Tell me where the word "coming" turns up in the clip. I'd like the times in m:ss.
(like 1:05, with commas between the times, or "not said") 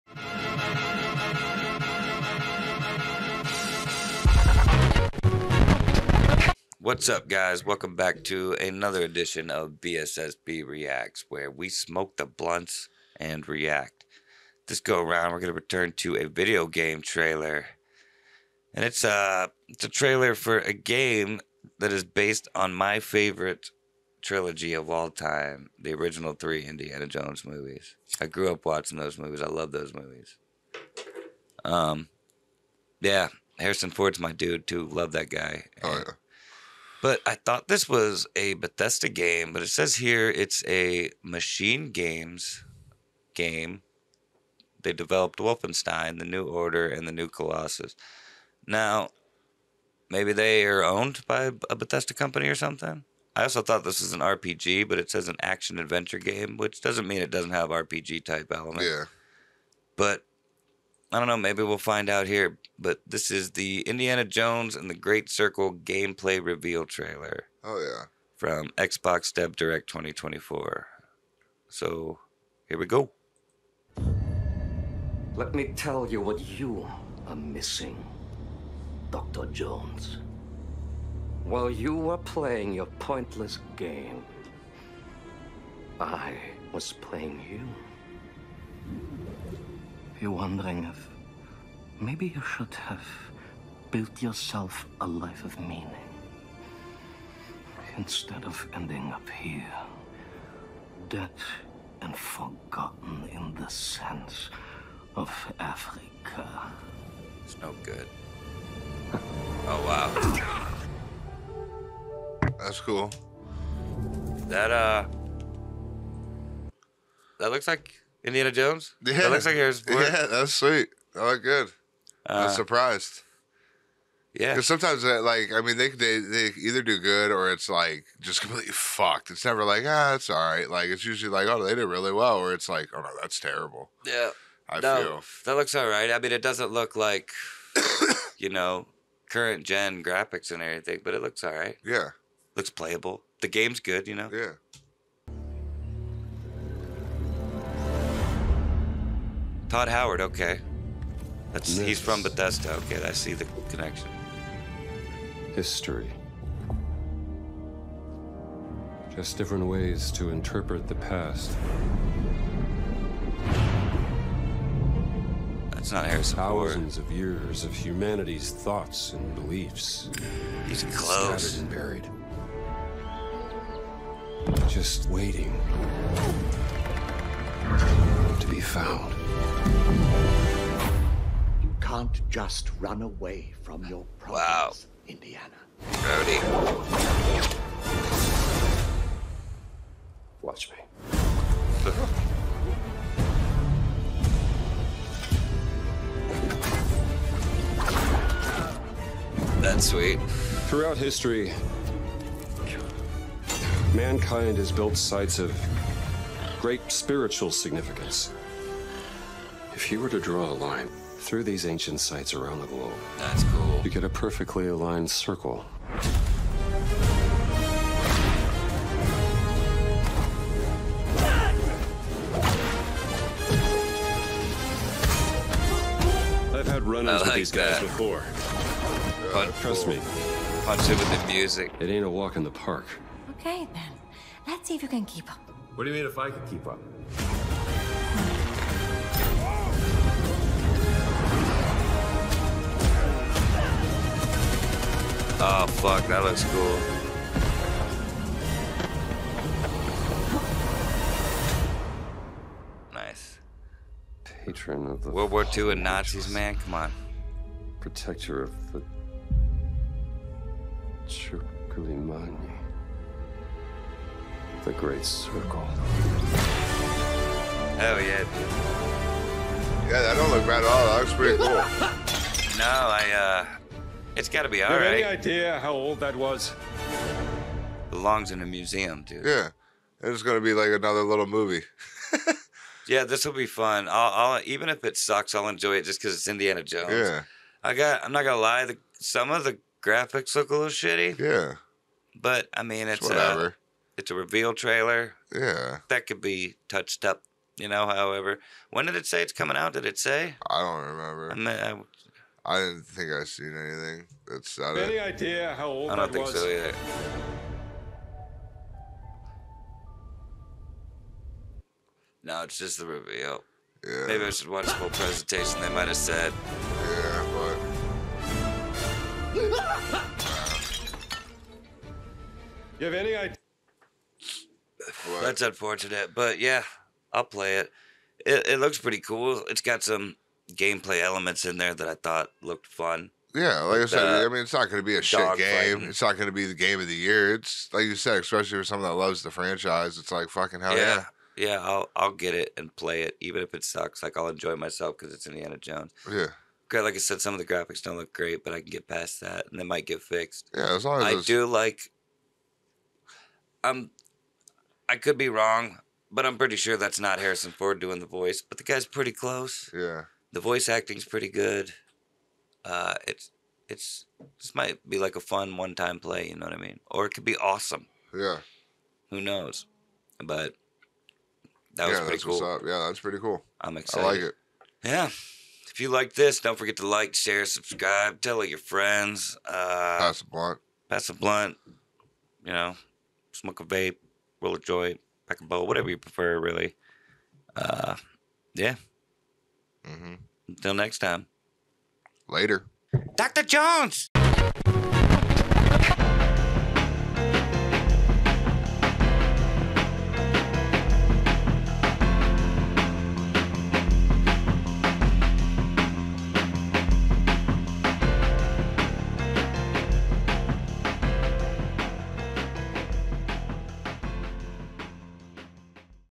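4:59.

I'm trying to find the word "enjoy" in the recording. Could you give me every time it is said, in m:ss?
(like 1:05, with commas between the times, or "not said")
4:45, 5:44.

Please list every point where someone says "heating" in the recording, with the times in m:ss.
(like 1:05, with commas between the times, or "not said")
not said.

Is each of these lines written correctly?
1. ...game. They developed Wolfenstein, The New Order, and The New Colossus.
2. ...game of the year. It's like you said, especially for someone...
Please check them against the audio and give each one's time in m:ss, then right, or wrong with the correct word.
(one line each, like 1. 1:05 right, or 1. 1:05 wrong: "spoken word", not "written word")
1. 0:43 right
2. 5:36 right.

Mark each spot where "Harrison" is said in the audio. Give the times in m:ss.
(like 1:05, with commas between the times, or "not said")
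0:33, 1:59, 2:46, 5:57.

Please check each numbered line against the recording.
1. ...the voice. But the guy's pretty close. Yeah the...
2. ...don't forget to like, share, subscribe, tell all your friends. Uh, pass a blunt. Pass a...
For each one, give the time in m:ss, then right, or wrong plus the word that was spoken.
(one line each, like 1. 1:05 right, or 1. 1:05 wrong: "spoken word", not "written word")
1. 5:57 right
2. 6:16 right.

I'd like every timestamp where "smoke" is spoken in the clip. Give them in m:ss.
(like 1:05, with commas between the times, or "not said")
0:11, 6:23.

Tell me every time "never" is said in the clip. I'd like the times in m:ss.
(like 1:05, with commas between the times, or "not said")
2:09.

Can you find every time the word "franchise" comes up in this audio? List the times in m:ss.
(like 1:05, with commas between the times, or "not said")
5:39.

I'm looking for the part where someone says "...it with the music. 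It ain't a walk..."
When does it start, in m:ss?
3:50.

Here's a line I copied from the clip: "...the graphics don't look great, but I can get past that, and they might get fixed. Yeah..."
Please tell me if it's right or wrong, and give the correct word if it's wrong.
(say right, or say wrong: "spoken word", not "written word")
right.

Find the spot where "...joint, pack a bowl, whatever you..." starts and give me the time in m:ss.
6:24.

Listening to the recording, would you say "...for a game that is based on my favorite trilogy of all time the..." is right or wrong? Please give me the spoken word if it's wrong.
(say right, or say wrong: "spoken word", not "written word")
right.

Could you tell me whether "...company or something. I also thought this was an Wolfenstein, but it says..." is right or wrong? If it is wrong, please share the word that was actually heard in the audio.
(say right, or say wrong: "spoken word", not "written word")
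wrong: "RPG", not "Wolfenstein".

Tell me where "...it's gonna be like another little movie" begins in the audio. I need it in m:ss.
4:40.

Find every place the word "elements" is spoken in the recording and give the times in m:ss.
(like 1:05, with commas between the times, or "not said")
0:58, 5:31.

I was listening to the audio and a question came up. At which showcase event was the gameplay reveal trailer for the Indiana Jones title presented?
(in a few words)
Xbox Dev Direct 2024.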